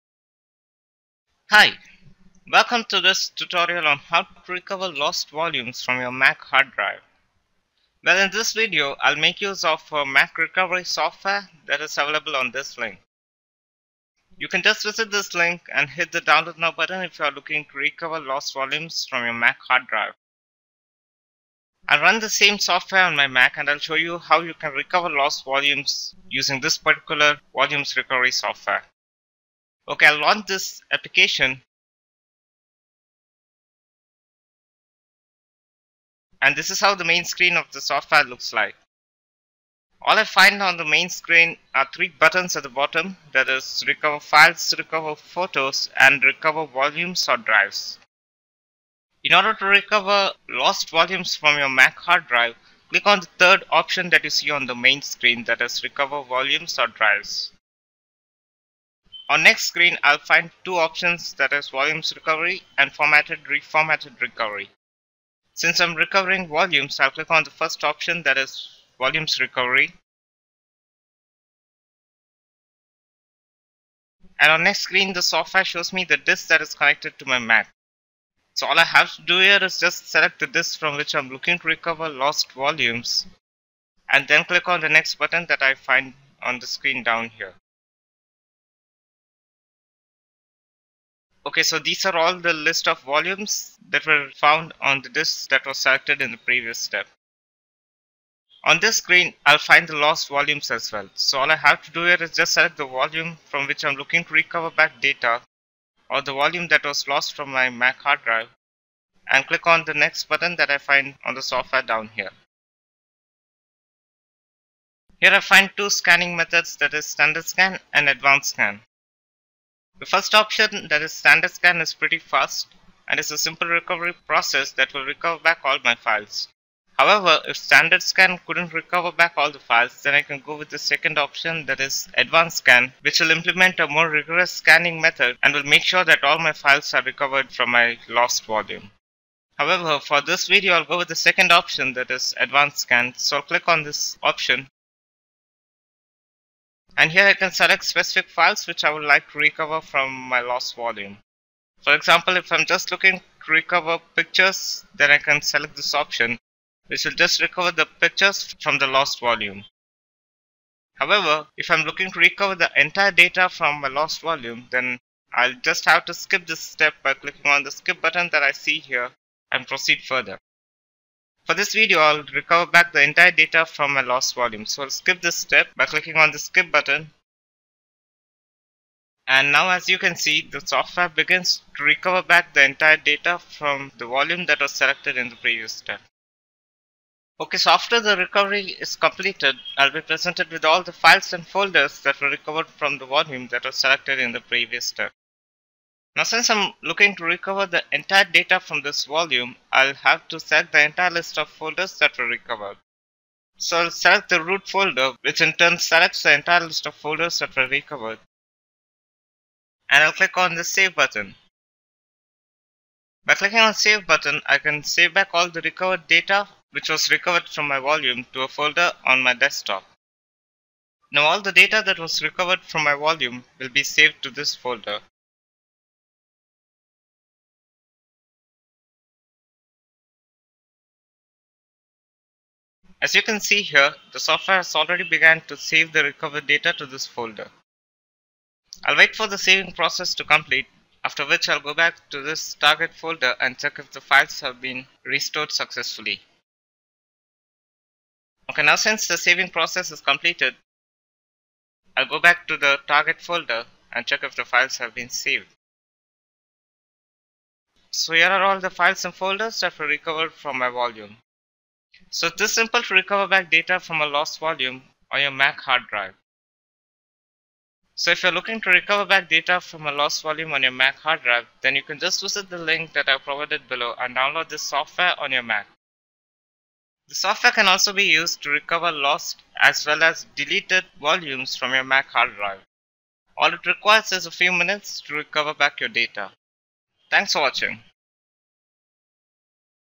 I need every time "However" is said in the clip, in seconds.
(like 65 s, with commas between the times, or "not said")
126 s, 139 s, 160 s.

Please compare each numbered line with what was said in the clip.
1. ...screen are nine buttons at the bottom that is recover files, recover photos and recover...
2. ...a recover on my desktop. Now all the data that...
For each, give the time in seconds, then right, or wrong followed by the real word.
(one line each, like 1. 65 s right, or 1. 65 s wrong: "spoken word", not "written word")
1. 41 s wrong: "three", not "nine"
2. 218 s wrong: "folder", not "recover".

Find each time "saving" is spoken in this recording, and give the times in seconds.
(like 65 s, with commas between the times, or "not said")
239 s, 249 s.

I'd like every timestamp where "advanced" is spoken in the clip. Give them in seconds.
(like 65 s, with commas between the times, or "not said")
118 s, 132 s, 142 s.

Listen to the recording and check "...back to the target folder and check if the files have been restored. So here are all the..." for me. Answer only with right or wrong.
wrong.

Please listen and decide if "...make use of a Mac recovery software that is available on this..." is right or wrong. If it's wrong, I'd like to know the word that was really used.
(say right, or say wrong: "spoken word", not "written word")
right.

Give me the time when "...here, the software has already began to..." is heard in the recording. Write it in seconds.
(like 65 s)
233 s.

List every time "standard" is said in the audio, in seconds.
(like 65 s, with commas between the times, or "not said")
117 s, 121 s, 127 s.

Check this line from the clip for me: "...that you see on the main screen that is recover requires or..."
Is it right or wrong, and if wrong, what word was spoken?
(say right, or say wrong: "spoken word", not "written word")
wrong: "volumes", not "requires".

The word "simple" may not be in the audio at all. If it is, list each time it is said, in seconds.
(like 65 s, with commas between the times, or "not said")
123 s, 262 s.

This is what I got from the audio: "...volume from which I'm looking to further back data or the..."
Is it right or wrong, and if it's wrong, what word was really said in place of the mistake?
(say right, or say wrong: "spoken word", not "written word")
wrong: "recover", not "further".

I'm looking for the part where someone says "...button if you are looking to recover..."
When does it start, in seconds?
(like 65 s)
16 s.